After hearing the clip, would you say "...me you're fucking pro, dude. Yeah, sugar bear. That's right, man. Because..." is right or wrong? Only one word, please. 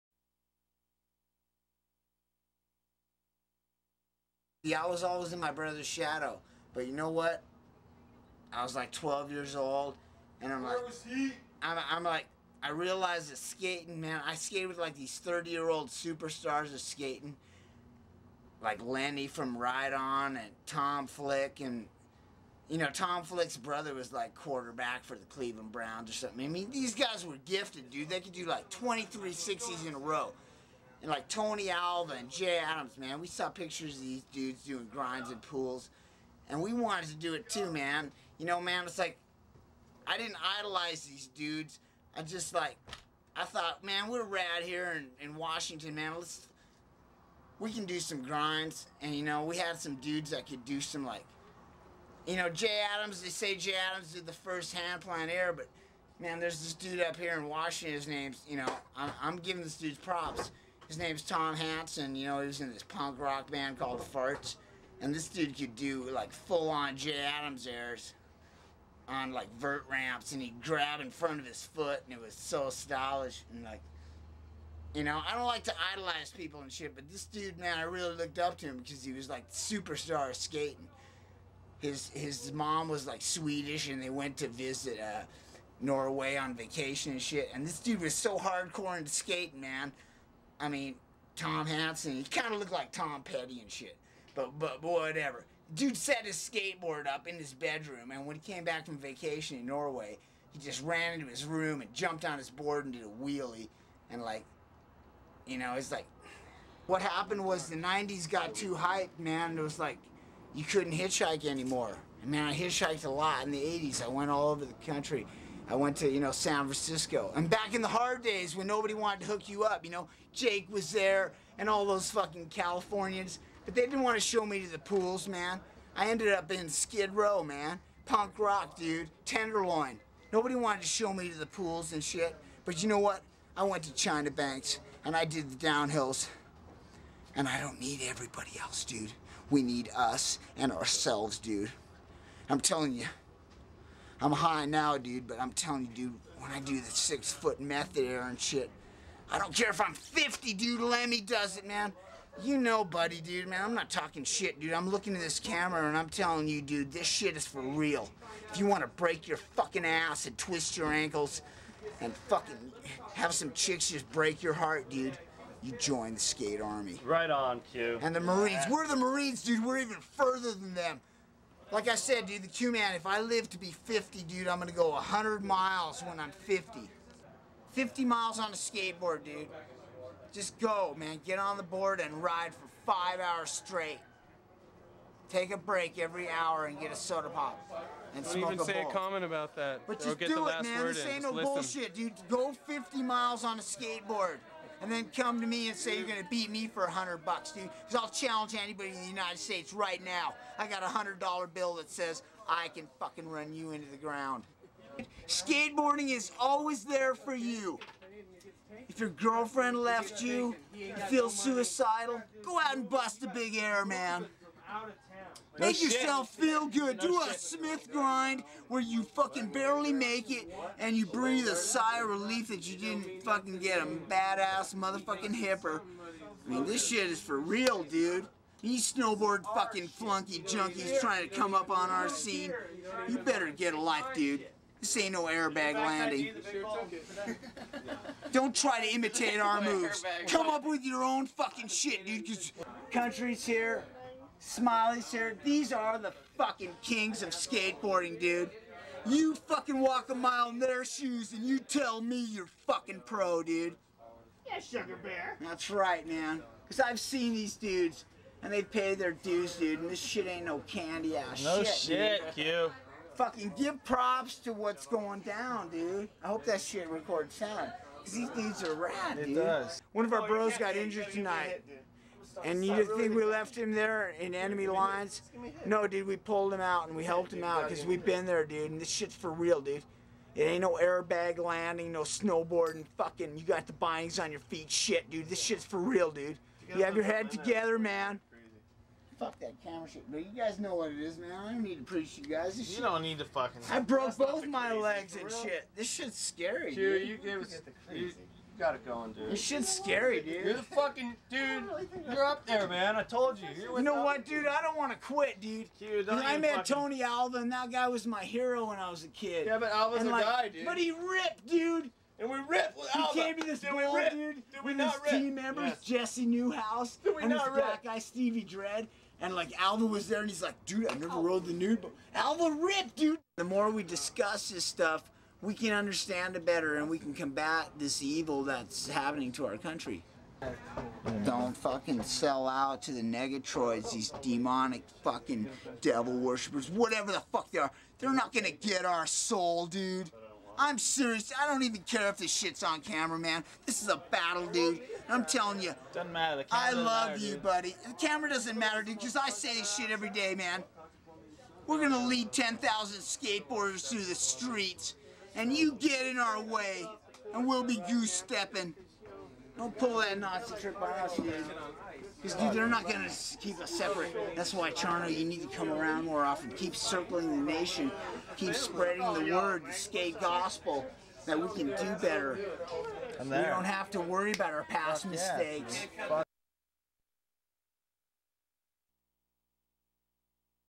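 right.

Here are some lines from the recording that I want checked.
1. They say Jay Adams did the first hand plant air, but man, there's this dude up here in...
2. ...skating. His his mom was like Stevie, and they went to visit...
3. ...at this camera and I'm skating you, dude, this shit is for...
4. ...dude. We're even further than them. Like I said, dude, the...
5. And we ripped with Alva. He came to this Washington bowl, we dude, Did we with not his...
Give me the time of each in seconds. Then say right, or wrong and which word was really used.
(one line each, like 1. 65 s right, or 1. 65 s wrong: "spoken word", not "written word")
1. 53 s right
2. 80 s wrong: "Swedish", not "Stevie"
3. 155 s wrong: "telling", not "skating"
4. 169 s right
5. 312 s wrong: "Did", not "Washington".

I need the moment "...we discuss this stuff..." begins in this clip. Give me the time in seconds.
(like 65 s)
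323 s.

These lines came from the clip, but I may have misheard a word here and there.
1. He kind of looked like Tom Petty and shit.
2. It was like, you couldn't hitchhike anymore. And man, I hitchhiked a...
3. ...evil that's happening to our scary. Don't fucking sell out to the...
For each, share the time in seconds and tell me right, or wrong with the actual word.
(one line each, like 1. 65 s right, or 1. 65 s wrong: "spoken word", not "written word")
1. 92 s right
2. 109 s right
3. 328 s wrong: "country", not "scary".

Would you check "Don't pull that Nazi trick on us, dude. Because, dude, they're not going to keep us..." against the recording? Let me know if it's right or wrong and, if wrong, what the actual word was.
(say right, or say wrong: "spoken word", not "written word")
right.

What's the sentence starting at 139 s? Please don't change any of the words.
We need us and ourselves, dude.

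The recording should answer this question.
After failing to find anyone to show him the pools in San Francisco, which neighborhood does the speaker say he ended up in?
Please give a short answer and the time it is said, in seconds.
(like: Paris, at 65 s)
Tenderloin, at 129 s.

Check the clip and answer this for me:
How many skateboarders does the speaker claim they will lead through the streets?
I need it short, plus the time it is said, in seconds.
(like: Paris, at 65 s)
10,000, at 352 s.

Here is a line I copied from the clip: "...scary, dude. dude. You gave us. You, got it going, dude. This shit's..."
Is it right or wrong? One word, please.
right.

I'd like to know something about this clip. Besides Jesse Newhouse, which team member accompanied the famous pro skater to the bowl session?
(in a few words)
Stevie Dredd.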